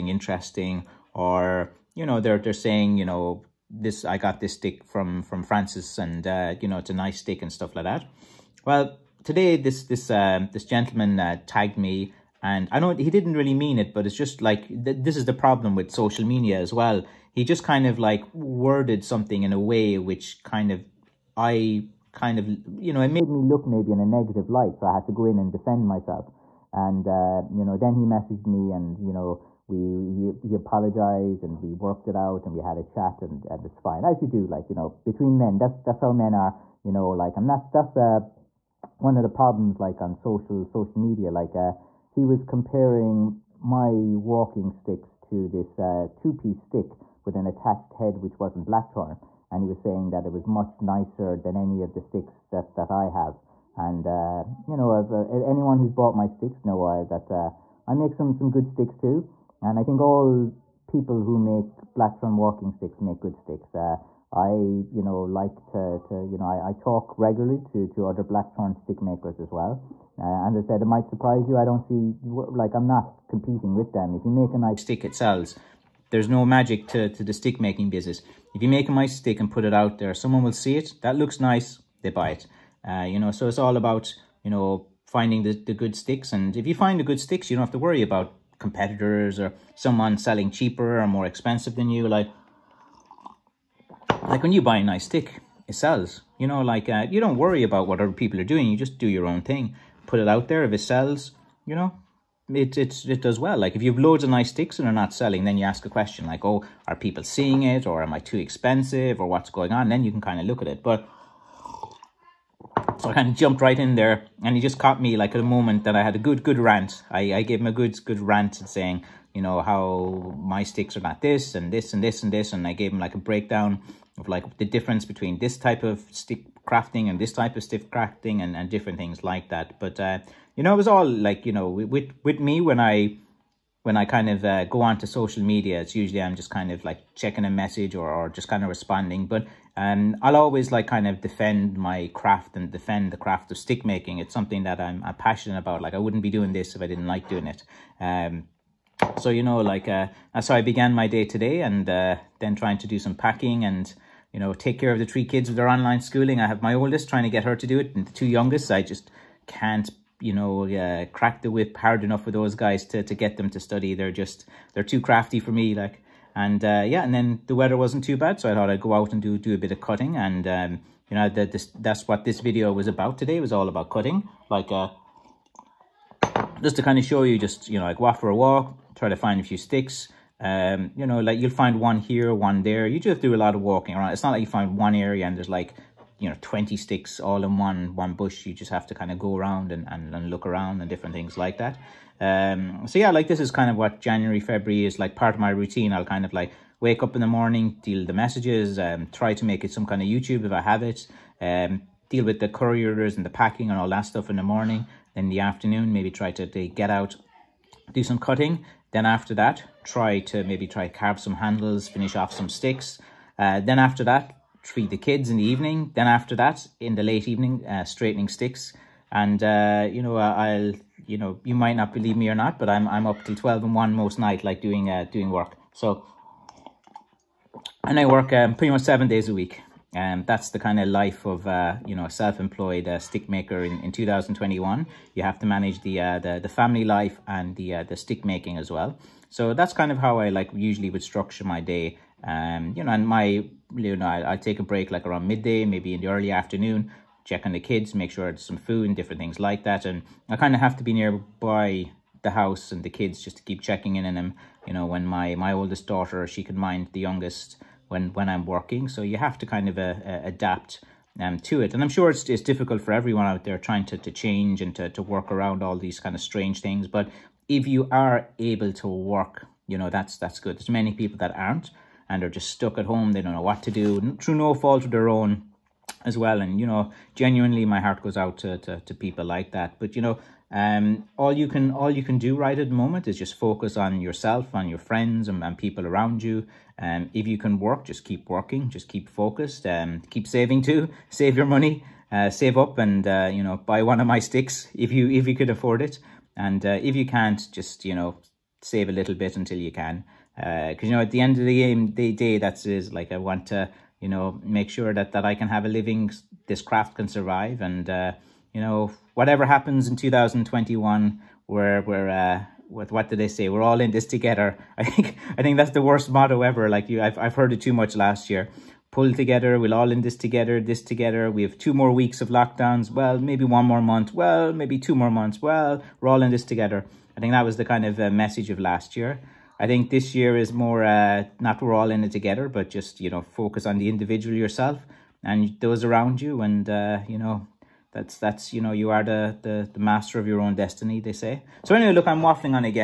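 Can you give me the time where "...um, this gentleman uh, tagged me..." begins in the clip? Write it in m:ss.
0:10.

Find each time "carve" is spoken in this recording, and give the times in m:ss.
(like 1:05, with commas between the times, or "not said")
3:30.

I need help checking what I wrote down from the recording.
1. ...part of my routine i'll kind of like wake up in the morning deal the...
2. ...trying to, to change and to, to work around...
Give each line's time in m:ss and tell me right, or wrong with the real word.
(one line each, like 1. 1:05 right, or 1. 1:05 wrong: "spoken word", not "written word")
1. 3:15 right
2. 4:23 right.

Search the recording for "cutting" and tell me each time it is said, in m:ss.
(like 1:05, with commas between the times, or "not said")
2:49, 2:53, 3:28.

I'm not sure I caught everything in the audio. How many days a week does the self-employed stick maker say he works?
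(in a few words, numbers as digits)
7.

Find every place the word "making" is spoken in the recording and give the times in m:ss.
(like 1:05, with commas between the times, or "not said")
1:17, 2:23, 3:58.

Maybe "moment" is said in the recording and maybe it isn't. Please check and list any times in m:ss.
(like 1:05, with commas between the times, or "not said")
1:55, 4:42.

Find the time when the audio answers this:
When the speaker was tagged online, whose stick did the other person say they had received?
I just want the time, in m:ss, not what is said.
0:05.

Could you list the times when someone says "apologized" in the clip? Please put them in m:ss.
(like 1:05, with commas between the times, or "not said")
0:30.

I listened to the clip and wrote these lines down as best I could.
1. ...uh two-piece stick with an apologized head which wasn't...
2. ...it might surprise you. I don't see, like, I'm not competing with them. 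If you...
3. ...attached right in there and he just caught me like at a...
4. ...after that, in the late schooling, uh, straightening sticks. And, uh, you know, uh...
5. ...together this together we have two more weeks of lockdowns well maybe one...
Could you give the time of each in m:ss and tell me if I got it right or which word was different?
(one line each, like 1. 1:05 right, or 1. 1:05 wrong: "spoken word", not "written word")
1. 0:45 wrong: "attached", not "apologized"
2. 1:10 right
3. 1:53 wrong: "jumped", not "attached"
4. 3:36 wrong: "evening", not "schooling"
5. 5:20 right.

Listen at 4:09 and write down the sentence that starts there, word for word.
And I kind of have to be nearby the house and the kids just to keep checking in on them.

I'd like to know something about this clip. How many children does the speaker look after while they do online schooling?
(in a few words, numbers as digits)
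3.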